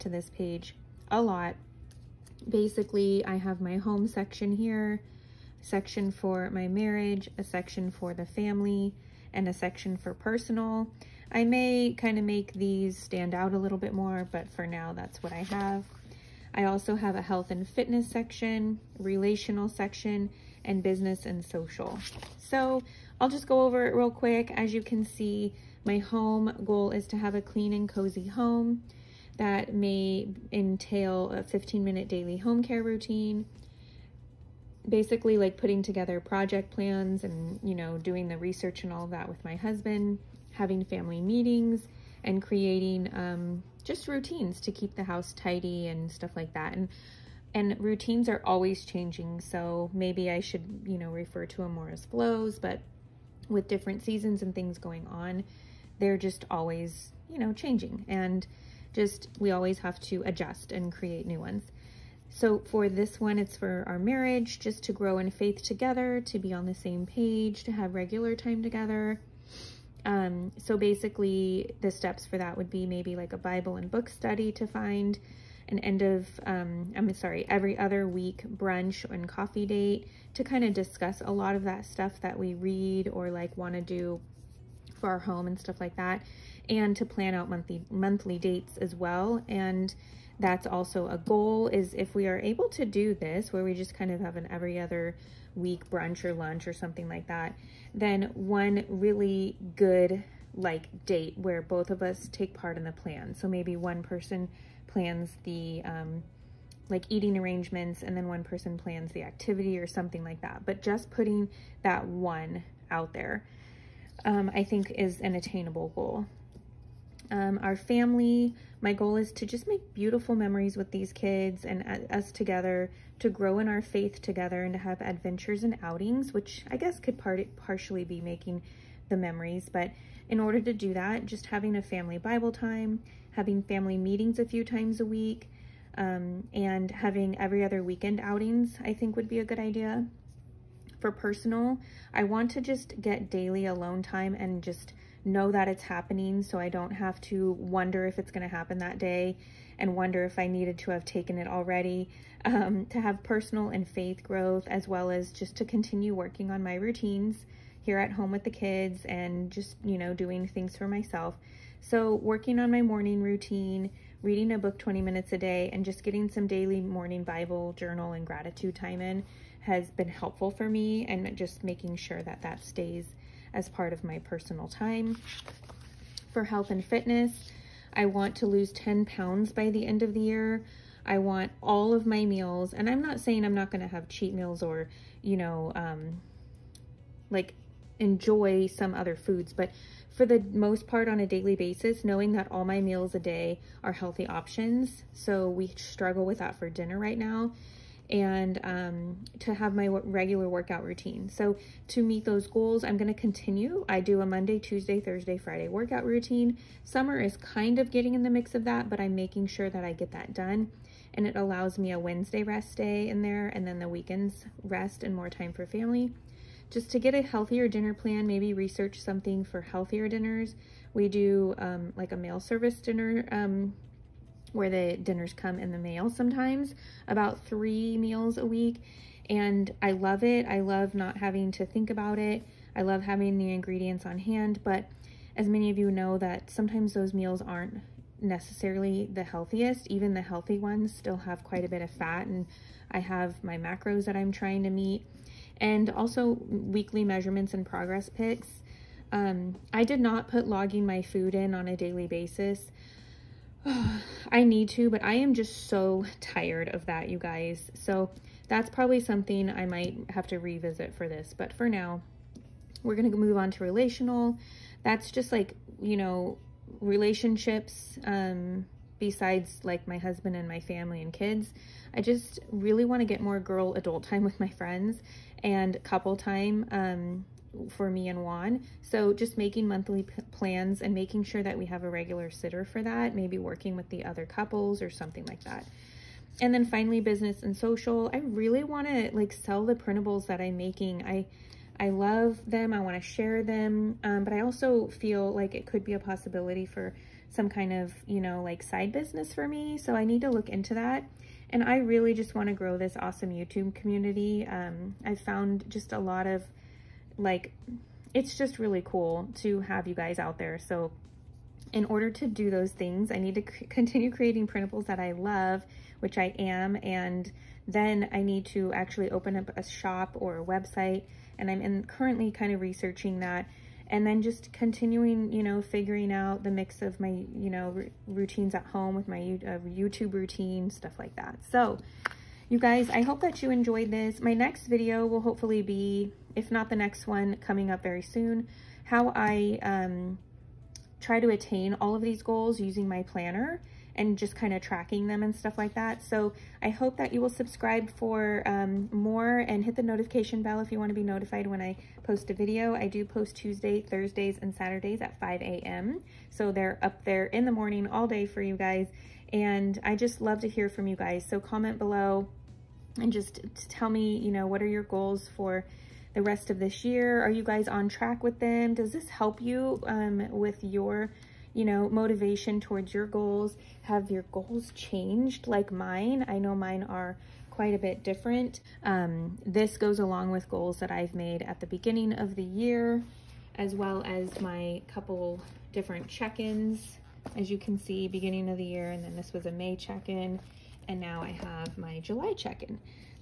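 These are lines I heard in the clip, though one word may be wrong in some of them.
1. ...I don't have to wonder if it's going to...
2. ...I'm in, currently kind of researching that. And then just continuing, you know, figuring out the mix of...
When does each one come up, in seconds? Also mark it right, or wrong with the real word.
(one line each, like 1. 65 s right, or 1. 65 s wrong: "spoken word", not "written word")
1. 146 s right
2. 321 s right.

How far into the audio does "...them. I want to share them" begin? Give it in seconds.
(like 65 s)
292 s.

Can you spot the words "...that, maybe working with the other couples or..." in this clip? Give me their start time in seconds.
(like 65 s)
282 s.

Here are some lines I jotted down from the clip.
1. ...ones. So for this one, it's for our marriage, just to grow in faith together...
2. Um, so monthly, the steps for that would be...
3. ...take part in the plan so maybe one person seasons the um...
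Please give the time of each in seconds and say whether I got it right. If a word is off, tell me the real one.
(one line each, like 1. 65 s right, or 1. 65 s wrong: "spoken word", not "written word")
1. 61 s right
2. 70 s wrong: "basically", not "monthly"
3. 102 s wrong: "plans", not "seasons".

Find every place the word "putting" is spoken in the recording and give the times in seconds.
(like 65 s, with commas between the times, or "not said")
35 s, 111 s.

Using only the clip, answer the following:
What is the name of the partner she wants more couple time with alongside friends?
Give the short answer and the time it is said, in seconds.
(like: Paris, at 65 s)
Juan, at 278 s.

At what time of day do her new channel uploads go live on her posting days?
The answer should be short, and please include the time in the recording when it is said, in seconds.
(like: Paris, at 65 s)
5 a.m., at 355 s.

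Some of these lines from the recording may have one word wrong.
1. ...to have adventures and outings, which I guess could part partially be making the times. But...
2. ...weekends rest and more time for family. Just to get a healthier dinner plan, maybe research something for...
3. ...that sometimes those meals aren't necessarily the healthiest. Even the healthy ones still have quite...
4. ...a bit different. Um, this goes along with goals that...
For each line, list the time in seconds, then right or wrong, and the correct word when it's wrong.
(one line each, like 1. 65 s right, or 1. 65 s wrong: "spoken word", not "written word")
1. 124 s wrong: "memories", not "times"
2. 213 s right
3. 236 s right
4. 377 s right.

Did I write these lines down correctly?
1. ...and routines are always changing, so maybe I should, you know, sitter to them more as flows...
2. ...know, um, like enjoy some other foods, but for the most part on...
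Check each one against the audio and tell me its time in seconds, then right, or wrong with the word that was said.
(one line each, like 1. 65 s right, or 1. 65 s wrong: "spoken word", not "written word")
1. 47 s wrong: "refer", not "sitter"
2. 185 s right.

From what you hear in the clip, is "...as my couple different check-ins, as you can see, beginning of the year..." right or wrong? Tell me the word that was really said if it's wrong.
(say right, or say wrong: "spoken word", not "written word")
right.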